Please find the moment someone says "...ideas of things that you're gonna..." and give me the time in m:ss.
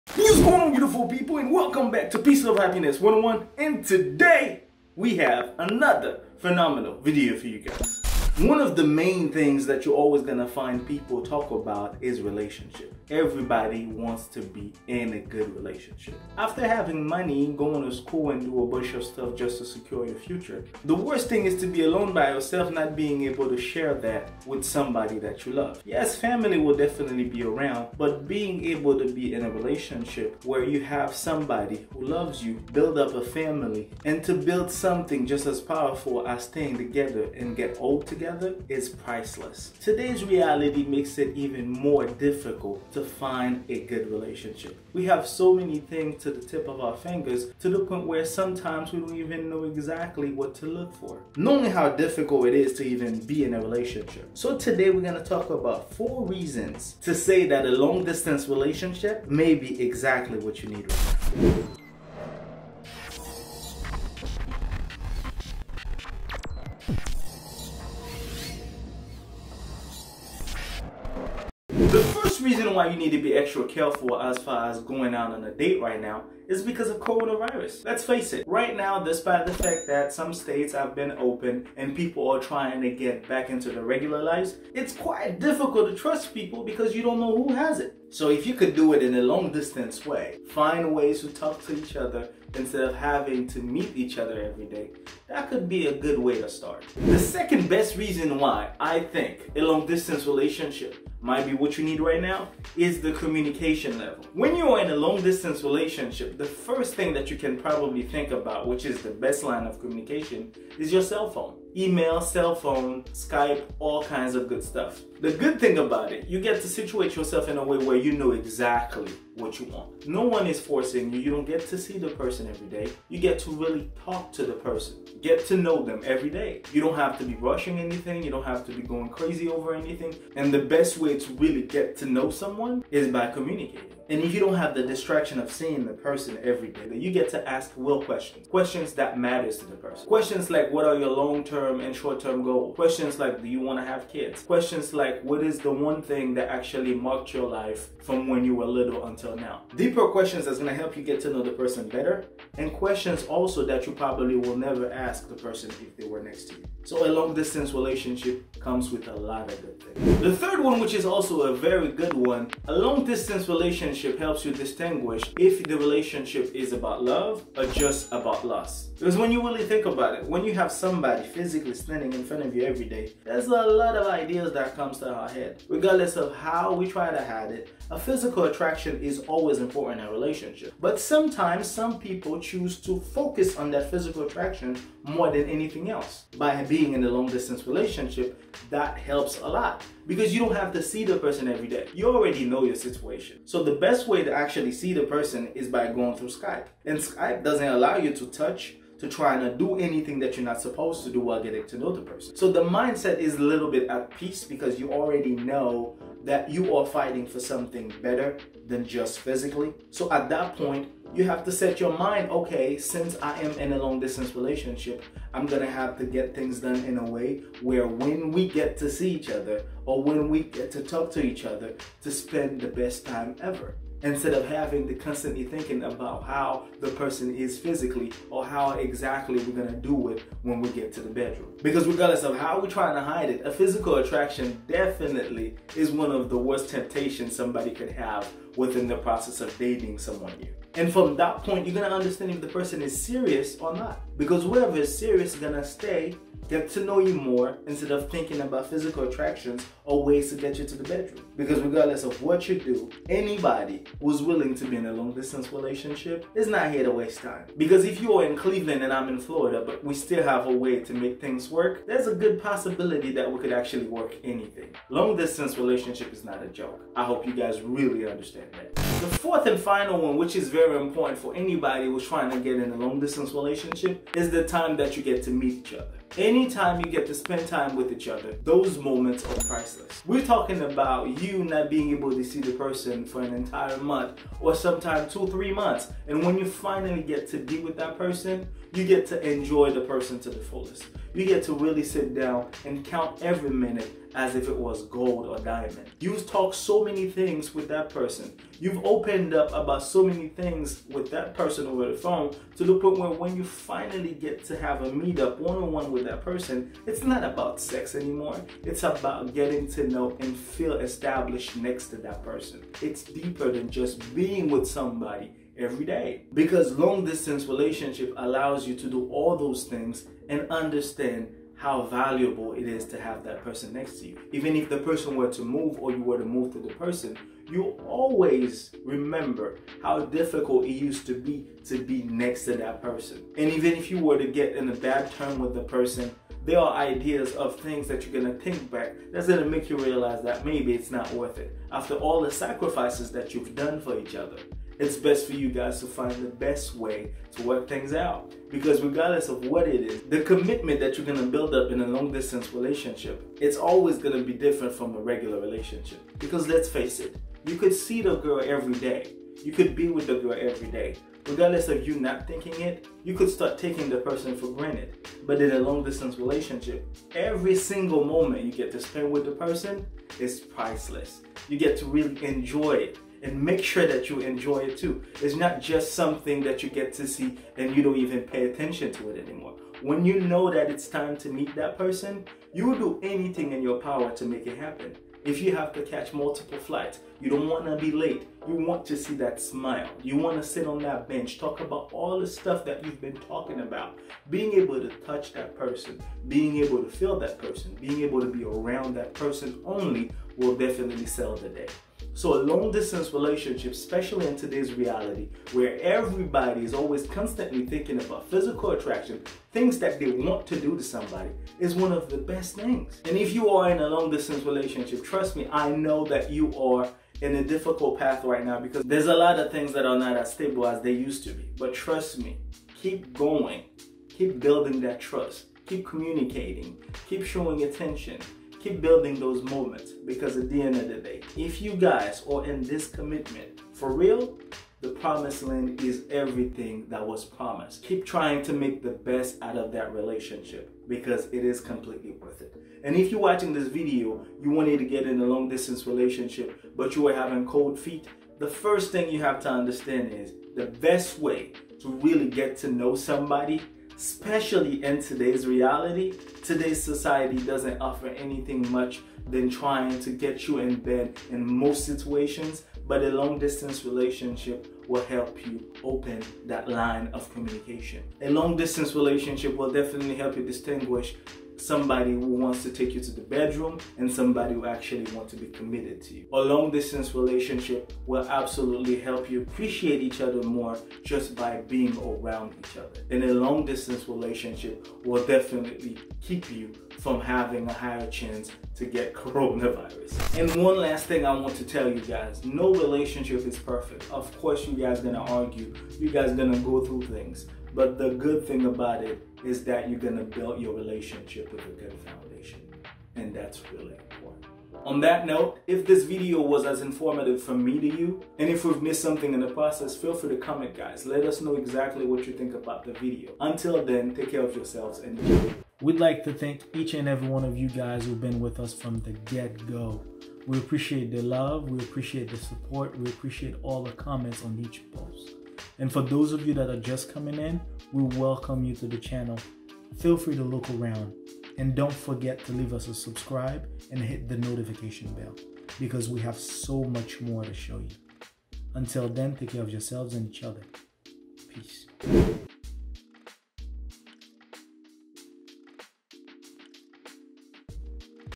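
5:36.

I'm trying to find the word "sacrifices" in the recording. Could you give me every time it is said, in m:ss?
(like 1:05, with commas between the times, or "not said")
5:42.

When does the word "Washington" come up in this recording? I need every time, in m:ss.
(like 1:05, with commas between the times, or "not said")
not said.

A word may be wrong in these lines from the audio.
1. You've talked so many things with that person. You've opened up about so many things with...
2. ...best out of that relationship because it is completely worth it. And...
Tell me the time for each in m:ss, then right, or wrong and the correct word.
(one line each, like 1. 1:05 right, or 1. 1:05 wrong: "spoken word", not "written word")
1. 4:55 right
2. 7:18 right.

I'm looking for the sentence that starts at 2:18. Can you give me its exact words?
Questions that matters to the person.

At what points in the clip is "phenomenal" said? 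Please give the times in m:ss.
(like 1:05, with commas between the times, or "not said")
0:06.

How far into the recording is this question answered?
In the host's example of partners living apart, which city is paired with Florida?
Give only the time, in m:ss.
4:18.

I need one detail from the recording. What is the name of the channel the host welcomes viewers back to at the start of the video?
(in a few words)
Peace, Love Happiness 101.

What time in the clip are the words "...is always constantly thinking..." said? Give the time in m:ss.
6:46.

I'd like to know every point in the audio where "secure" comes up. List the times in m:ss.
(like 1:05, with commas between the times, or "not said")
0:19.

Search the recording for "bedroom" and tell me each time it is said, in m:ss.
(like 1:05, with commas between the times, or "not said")
3:51, 4:10, 7:53.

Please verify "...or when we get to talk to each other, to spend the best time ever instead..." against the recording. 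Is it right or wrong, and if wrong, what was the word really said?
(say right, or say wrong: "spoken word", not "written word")
right.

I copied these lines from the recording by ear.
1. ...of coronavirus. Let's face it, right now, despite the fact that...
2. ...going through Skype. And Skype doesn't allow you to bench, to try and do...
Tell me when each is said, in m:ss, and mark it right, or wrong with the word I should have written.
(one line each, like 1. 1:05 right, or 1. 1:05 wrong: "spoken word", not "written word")
1. 1:16 right
2. 3:15 wrong: "touch", not "bench".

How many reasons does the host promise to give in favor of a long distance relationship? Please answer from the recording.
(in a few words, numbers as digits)
4.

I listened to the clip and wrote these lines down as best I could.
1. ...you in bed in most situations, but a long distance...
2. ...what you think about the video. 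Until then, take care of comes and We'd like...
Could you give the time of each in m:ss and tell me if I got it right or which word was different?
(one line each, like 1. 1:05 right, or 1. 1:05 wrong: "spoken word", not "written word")
1. 7:40 right
2. 8:32 wrong: "yourselves", not "comes".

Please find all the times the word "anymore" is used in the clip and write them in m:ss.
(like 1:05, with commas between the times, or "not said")
5:07, 6:19.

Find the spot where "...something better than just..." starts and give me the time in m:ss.
3:27.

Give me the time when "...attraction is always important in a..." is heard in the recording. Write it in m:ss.
2:58.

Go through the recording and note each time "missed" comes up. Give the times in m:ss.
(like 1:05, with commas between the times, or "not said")
8:28.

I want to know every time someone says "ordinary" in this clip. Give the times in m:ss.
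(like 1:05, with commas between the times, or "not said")
not said.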